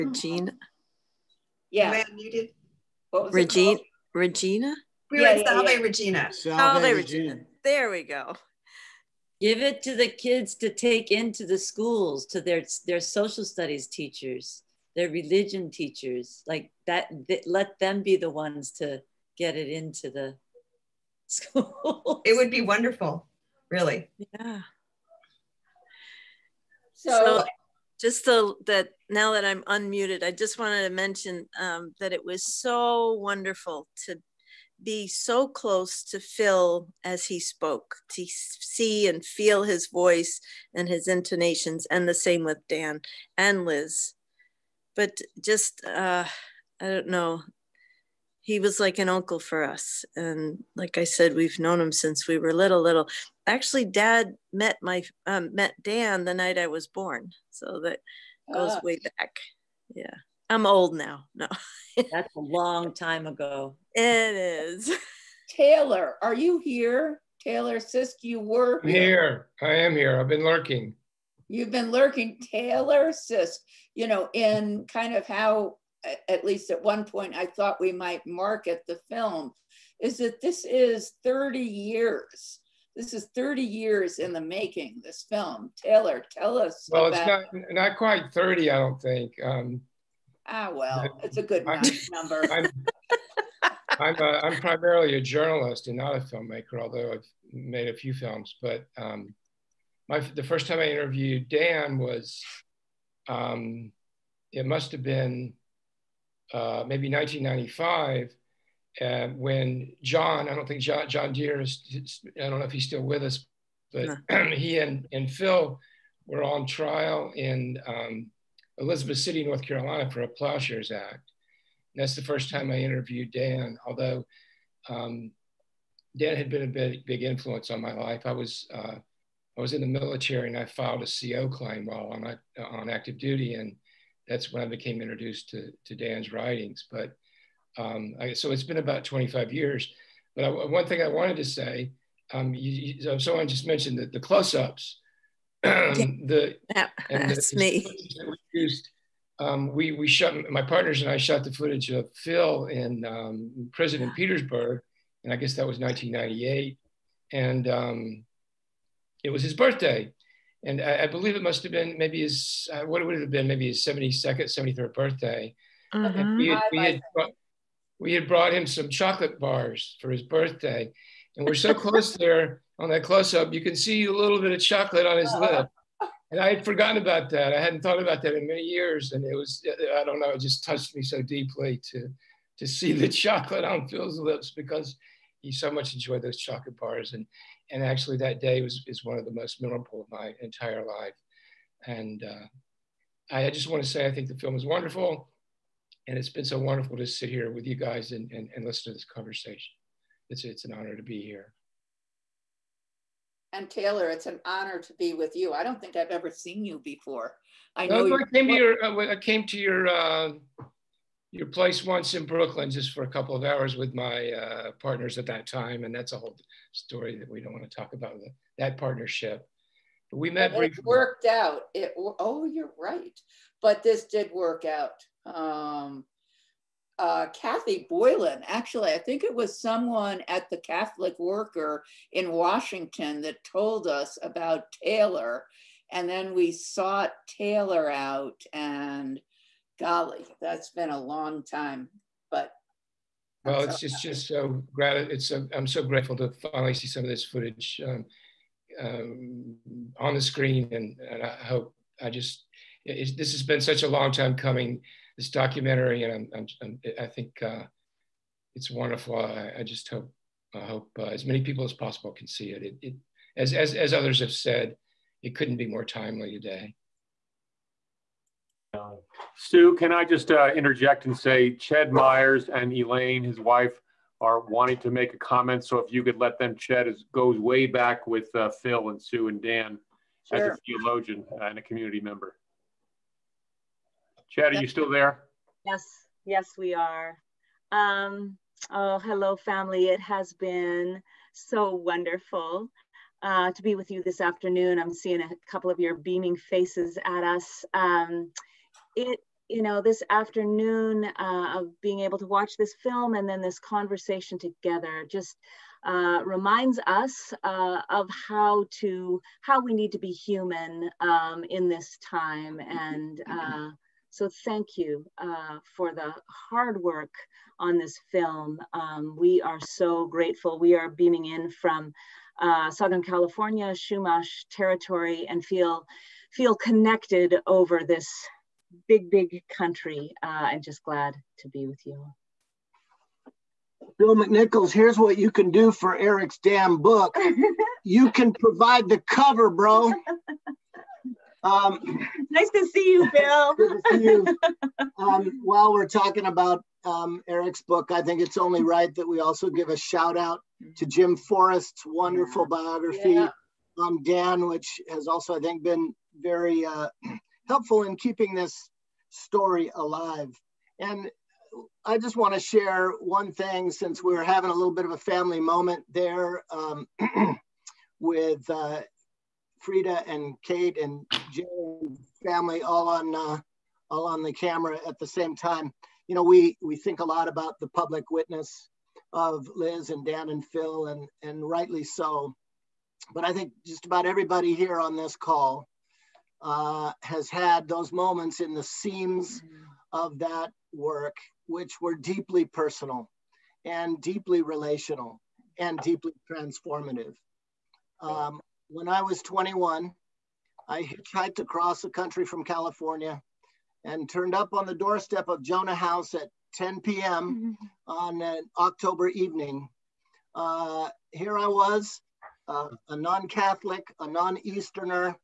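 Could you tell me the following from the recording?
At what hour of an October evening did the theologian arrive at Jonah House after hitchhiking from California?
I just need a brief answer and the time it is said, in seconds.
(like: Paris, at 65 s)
10 p.m., at 406 s.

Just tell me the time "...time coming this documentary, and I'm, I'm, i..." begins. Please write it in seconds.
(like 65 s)
254 s.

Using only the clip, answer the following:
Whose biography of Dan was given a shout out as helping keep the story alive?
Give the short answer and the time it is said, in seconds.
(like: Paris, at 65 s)
Jim Forrest, at 350 s.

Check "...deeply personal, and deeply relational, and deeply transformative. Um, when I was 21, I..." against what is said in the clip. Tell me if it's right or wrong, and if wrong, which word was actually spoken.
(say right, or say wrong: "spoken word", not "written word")
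right.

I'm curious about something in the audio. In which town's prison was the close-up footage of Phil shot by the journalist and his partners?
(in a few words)
Petersburg.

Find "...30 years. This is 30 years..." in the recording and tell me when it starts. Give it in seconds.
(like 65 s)
81 s.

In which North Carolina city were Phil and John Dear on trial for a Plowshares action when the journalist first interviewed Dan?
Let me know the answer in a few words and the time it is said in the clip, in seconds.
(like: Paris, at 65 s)
Elizabeth City, at 118 s.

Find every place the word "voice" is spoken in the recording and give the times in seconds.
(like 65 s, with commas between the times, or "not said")
39 s.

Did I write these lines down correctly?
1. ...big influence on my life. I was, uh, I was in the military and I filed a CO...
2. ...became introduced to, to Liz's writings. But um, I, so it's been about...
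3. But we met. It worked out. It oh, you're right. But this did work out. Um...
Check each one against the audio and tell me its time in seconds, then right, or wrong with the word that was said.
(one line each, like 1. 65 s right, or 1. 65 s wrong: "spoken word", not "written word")
1. 127 s right
2. 134 s wrong: "Dan", not "Liz"
3. 220 s right.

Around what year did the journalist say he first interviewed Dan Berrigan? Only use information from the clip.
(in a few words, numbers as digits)
1995.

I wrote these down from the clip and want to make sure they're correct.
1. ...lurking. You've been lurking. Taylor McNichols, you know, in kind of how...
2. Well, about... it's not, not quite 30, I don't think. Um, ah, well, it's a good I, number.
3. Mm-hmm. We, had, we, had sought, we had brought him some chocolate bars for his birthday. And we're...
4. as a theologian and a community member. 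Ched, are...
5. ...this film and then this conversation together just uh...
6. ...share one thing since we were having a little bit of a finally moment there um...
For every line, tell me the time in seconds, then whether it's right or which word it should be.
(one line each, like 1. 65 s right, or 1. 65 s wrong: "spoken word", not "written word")
1. 70 s wrong: "Sisk", not "McNichols"
2. 86 s right
3. 165 s wrong: "brought", not "sought"
4. 280 s right
5. 302 s right
6. 362 s wrong: "family", not "finally".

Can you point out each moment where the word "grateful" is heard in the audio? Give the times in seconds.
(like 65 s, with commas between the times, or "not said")
245 s, 320 s.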